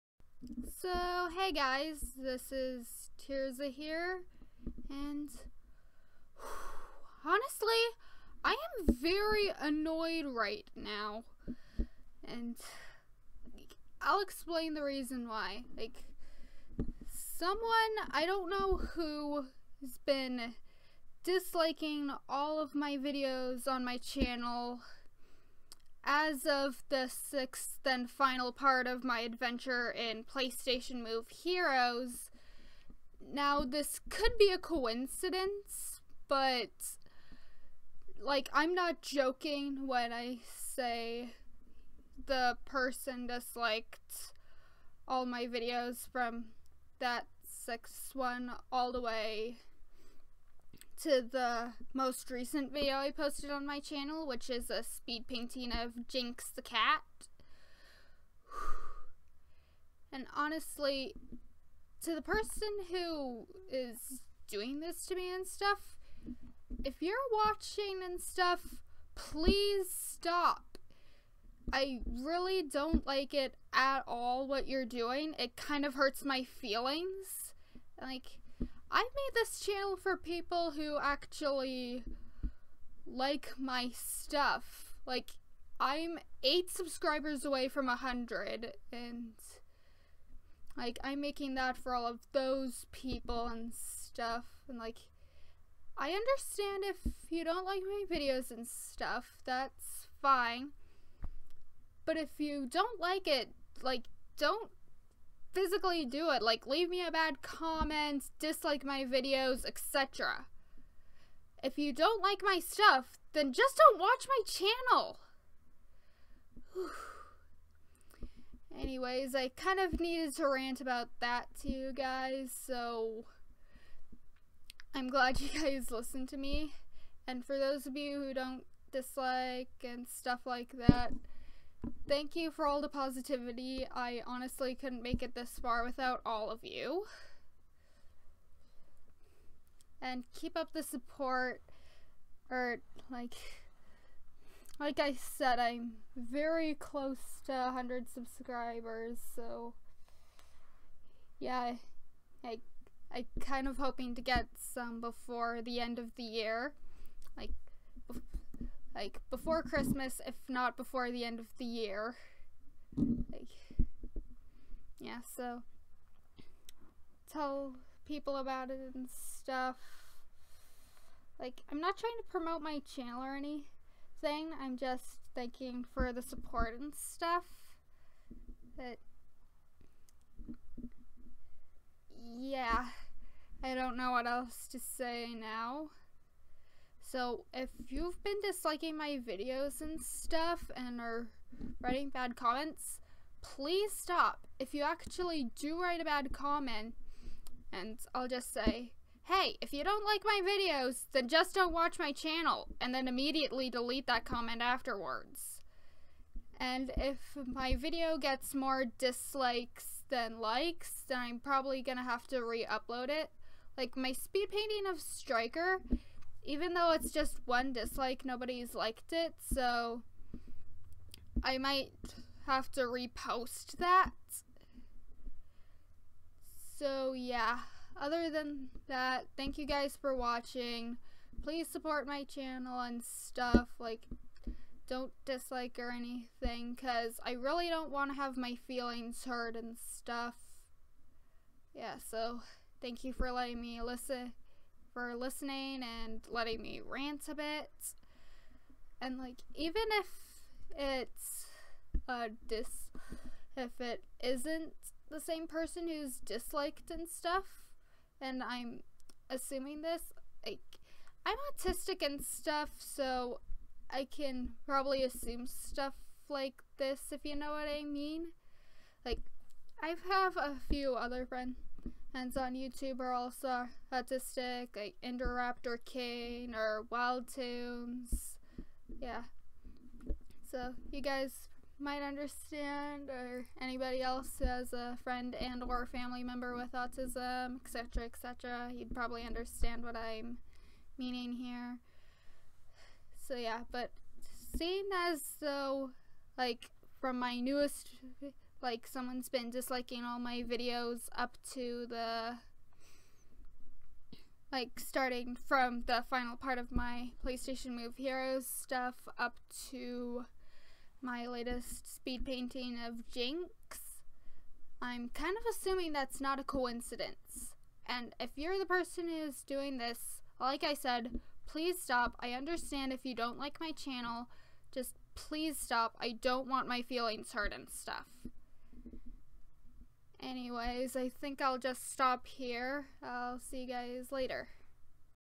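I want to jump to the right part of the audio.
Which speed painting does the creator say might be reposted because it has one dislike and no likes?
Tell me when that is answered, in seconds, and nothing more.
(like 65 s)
215 s.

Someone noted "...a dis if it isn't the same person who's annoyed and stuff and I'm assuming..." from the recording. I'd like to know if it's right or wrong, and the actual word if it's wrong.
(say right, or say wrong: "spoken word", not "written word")
wrong: "disliked", not "annoyed".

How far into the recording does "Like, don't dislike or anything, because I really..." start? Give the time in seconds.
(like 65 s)
233 s.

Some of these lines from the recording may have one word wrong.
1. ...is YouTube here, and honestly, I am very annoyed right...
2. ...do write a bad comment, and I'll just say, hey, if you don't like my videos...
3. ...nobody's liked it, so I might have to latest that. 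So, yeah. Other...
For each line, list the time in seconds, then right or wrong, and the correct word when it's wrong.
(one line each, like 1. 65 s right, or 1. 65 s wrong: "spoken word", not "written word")
1. 2 s wrong: "Tirzah", not "YouTube"
2. 195 s right
3. 218 s wrong: "repost", not "latest".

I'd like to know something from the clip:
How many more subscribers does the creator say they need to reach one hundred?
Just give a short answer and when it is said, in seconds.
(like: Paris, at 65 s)
8, at 86 s.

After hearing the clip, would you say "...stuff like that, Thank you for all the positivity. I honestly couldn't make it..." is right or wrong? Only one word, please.
right.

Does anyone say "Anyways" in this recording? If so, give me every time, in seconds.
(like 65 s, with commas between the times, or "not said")
118 s, 330 s.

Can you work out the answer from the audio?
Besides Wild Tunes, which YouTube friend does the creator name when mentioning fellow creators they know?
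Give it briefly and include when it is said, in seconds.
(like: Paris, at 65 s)
Indoraptor Kane, at 275 s.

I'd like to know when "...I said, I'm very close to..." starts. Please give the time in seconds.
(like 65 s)
144 s.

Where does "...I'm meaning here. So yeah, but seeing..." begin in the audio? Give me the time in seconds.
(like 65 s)
289 s.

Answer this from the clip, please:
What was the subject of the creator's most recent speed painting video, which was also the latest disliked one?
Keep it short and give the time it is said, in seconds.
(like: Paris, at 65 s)
Jinx the cat, at 56 s.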